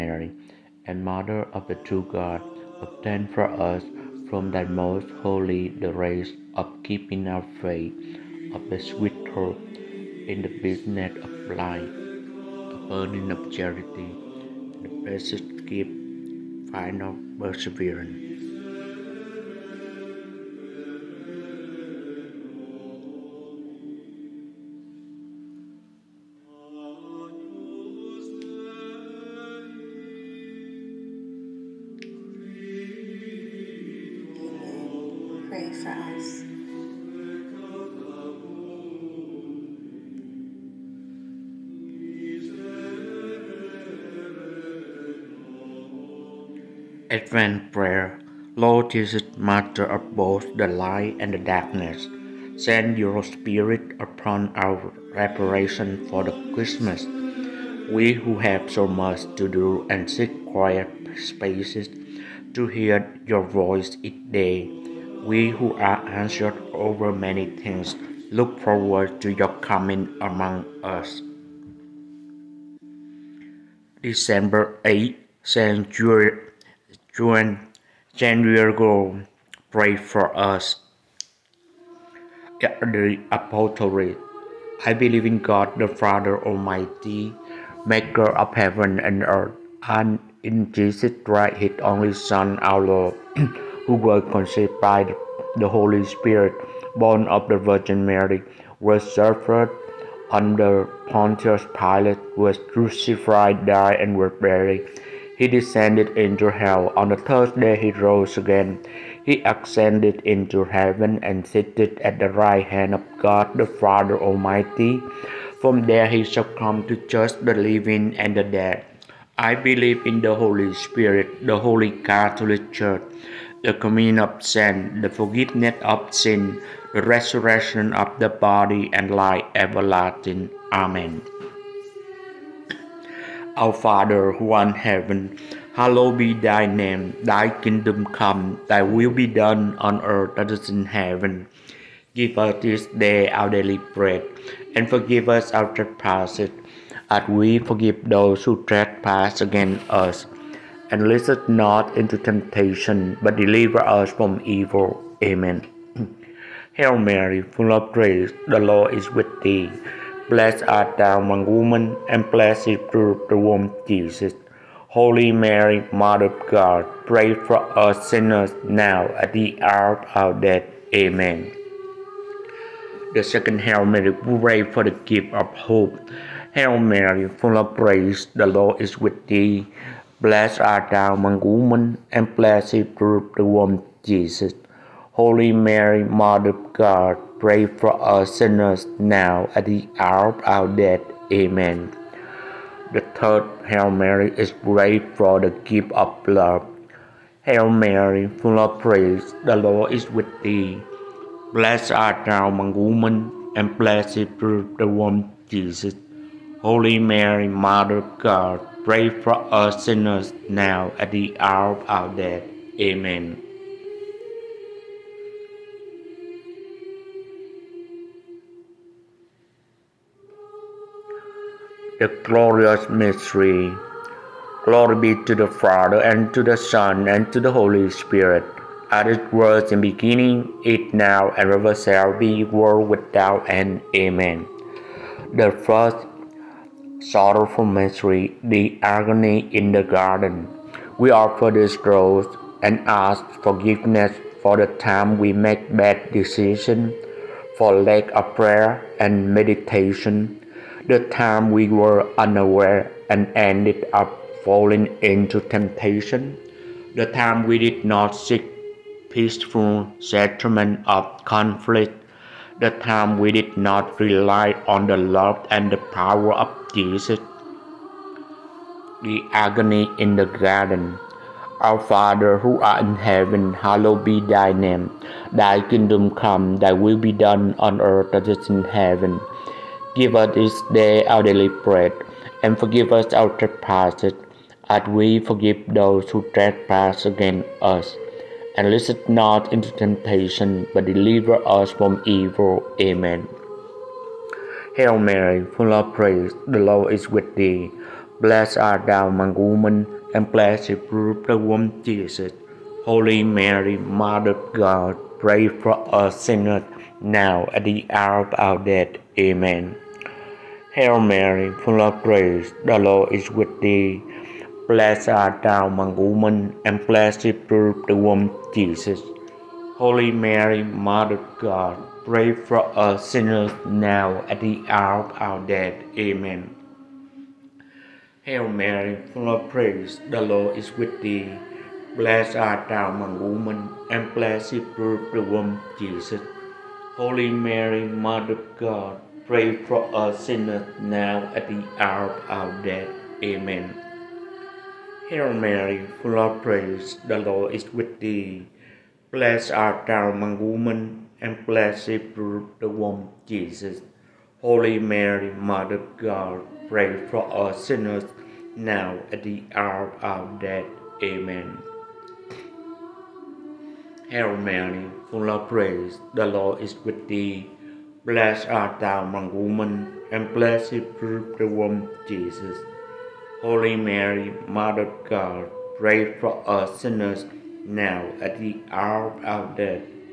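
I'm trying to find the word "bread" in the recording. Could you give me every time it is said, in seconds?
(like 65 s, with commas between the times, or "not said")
143 s, 281 s.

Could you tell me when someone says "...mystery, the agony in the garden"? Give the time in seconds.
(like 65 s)
237 s.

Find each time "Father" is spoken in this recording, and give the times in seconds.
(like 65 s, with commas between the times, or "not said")
85 s, 113 s, 133 s, 225 s, 271 s.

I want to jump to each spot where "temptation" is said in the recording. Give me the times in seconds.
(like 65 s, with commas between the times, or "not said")
152 s, 255 s, 289 s.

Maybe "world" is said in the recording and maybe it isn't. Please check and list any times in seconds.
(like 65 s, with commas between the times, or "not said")
232 s.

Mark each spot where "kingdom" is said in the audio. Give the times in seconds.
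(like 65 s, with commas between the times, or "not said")
137 s, 275 s.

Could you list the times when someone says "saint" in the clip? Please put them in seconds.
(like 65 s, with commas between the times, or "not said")
75 s, 124 s.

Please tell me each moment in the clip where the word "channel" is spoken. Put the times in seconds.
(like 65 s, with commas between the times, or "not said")
not said.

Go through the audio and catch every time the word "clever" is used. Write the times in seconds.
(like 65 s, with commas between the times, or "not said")
not said.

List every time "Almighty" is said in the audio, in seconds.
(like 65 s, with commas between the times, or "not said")
86 s, 114 s.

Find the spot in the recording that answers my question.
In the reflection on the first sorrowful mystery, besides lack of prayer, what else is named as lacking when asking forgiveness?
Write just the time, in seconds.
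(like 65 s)
249 s.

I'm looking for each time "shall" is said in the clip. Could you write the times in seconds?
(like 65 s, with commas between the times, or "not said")
116 s, 231 s.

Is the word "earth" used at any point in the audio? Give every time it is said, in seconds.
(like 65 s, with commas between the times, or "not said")
89 s, 140 s, 277 s.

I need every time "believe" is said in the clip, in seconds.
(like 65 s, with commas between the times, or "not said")
84 s, 119 s.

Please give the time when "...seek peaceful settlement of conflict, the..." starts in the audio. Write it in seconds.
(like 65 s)
258 s.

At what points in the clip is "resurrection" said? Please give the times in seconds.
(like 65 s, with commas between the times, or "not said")
127 s.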